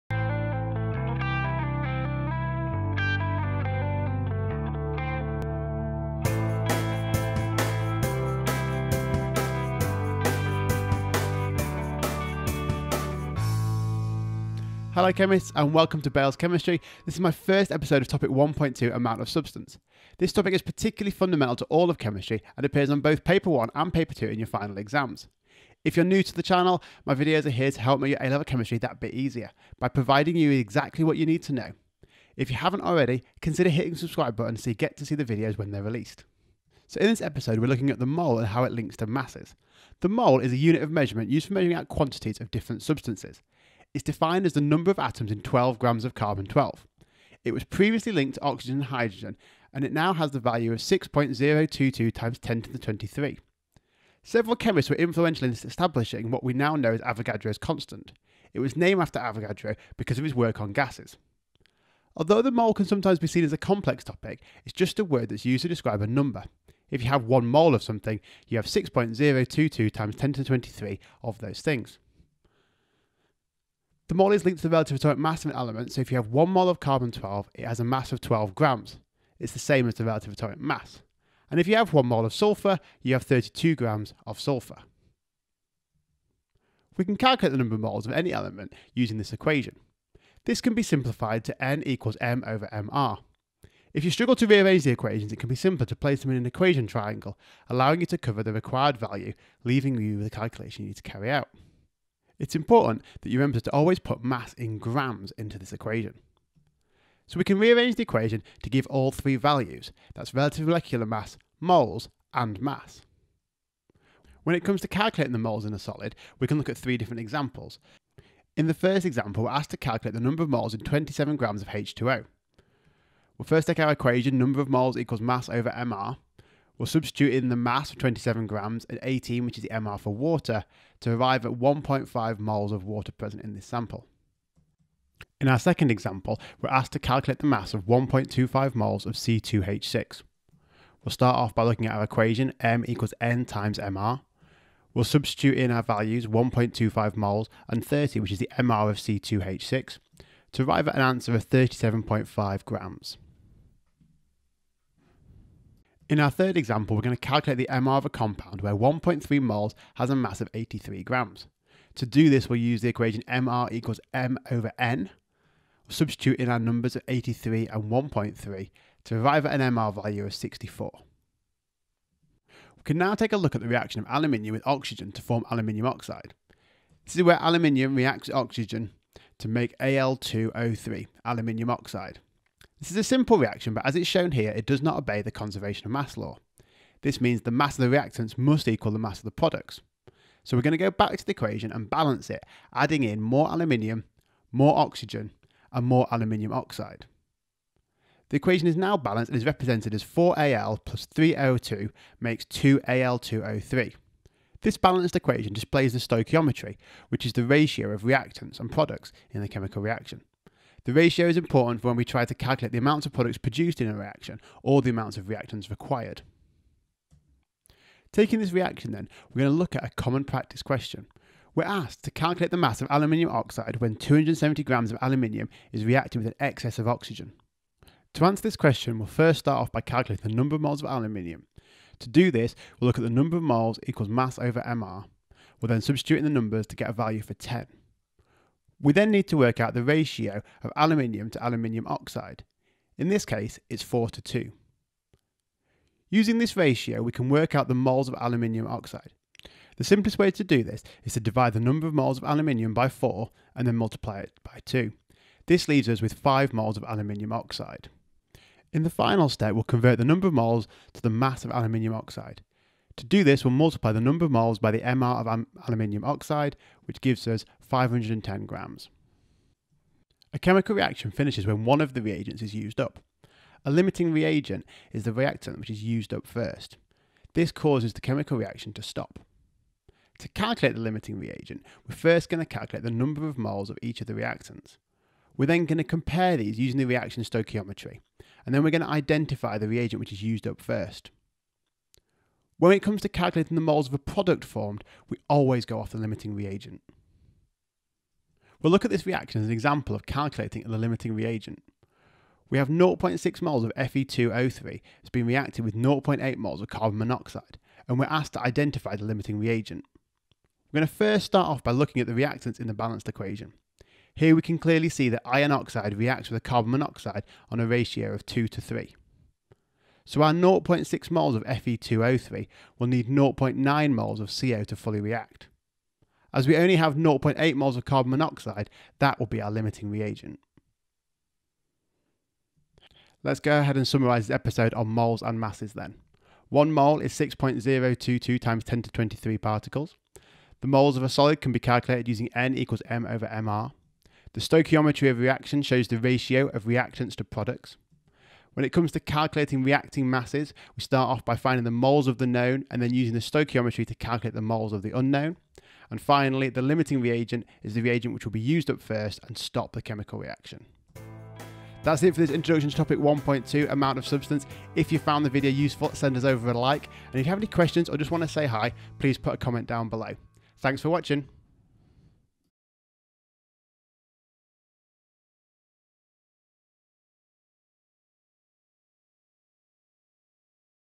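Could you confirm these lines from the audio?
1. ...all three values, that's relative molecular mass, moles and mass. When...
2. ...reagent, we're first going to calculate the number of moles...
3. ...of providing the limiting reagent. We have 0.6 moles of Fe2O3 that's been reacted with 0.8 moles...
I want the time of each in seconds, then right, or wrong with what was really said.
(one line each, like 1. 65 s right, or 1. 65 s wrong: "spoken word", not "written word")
1. 108 s right
2. 281 s right
3. 299 s wrong: "calculating", not "providing".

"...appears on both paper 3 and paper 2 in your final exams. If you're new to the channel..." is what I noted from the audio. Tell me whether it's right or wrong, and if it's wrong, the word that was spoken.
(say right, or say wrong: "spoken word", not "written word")
wrong: "1", not "3".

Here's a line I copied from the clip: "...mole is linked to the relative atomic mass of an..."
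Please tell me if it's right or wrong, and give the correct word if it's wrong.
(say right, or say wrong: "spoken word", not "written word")
right.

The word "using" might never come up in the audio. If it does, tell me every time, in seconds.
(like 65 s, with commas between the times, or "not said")
88 s, 246 s, 286 s, 342 s, 352 s.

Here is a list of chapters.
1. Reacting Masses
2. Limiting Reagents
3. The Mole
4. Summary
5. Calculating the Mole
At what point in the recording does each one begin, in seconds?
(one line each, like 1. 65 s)
1. 173 s
2. 260 s
3. 36 s
4. 333 s
5. 87 s.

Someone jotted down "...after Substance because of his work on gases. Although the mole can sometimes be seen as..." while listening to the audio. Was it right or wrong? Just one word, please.
wrong.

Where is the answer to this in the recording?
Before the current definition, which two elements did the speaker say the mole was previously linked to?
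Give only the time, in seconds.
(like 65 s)
48 s.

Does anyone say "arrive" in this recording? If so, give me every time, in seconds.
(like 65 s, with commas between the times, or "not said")
131 s, 150 s, 169 s.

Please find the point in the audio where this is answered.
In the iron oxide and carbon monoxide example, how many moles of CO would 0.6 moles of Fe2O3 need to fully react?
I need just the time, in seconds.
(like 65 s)
323 s.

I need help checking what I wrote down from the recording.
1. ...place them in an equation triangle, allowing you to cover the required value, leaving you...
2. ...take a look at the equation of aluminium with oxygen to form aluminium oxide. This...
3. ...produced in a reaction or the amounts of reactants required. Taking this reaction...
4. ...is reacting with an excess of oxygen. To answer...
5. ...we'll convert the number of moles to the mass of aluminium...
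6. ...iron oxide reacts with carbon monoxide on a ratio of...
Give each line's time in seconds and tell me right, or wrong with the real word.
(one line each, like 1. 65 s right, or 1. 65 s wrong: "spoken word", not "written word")
1. 95 s right
2. 173 s wrong: "reaction", not "equation"
3. 213 s right
4. 225 s right
5. 259 s right
6. 315 s right.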